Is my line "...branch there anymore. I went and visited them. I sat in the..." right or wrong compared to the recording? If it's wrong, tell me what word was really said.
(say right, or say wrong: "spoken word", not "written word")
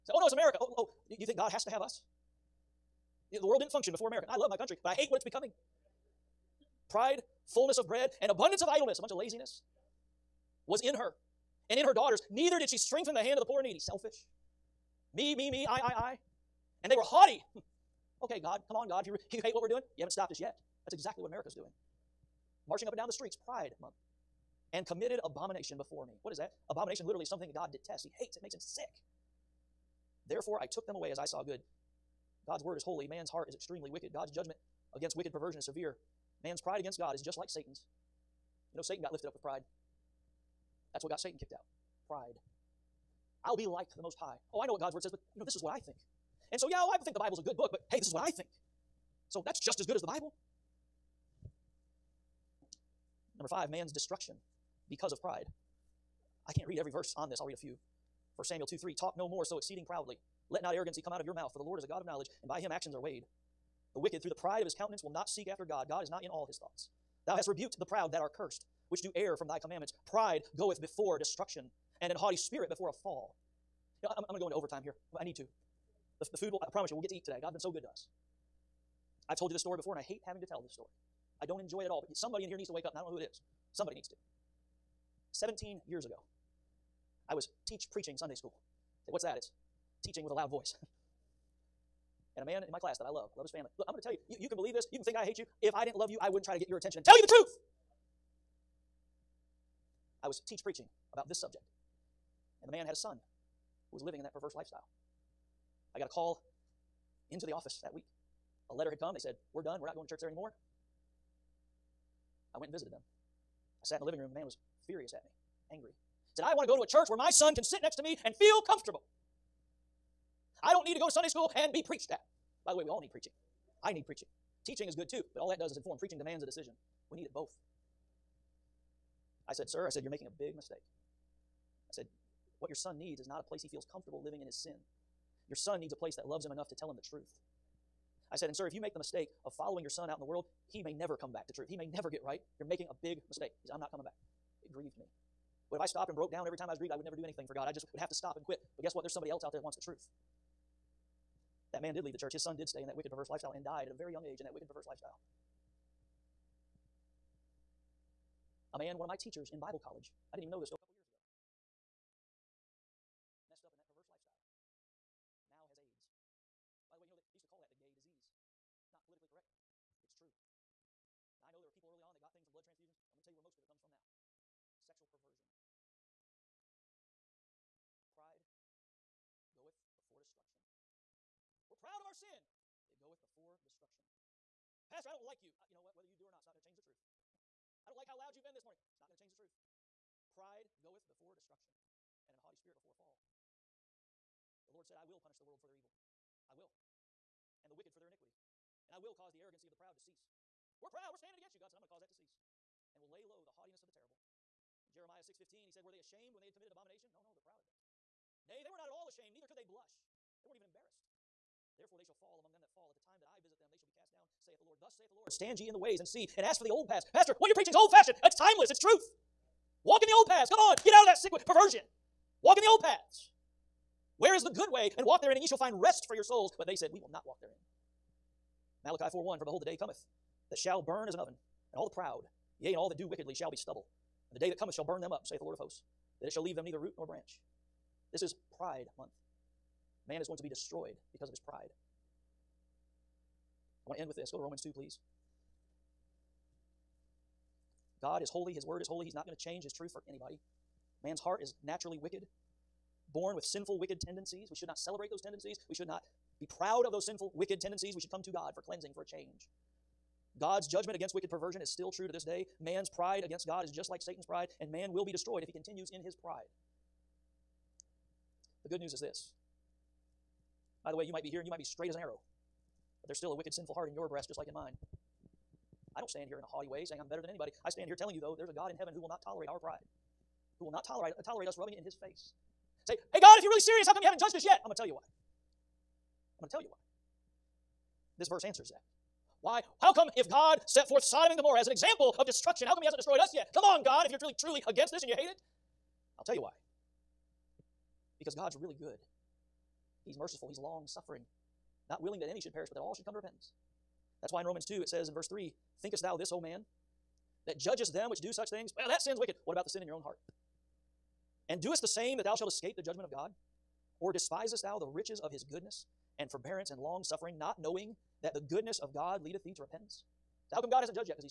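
wrong: "church", not "branch".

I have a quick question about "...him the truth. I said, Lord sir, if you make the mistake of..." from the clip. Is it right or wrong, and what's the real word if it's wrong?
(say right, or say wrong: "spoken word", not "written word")
wrong: "And", not "Lord".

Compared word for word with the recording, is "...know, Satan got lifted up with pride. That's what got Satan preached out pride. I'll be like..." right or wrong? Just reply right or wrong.
wrong.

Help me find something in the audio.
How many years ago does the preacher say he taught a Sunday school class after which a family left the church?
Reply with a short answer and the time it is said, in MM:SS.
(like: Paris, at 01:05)
17, at 01:25.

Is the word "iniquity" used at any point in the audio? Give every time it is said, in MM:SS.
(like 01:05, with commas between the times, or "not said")
03:18.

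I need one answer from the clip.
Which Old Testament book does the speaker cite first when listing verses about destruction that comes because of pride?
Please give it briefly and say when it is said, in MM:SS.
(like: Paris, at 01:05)
1 Samuel, at 00:58.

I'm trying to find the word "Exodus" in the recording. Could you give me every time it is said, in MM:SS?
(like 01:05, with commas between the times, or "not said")
not said.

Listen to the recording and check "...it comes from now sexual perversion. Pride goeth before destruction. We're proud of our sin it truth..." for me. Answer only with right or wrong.
wrong.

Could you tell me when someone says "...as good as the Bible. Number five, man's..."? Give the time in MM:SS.
00:49.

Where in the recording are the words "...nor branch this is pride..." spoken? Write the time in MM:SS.
03:56.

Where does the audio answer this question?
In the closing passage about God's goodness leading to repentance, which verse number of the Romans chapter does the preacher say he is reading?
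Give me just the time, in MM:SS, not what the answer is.
05:05.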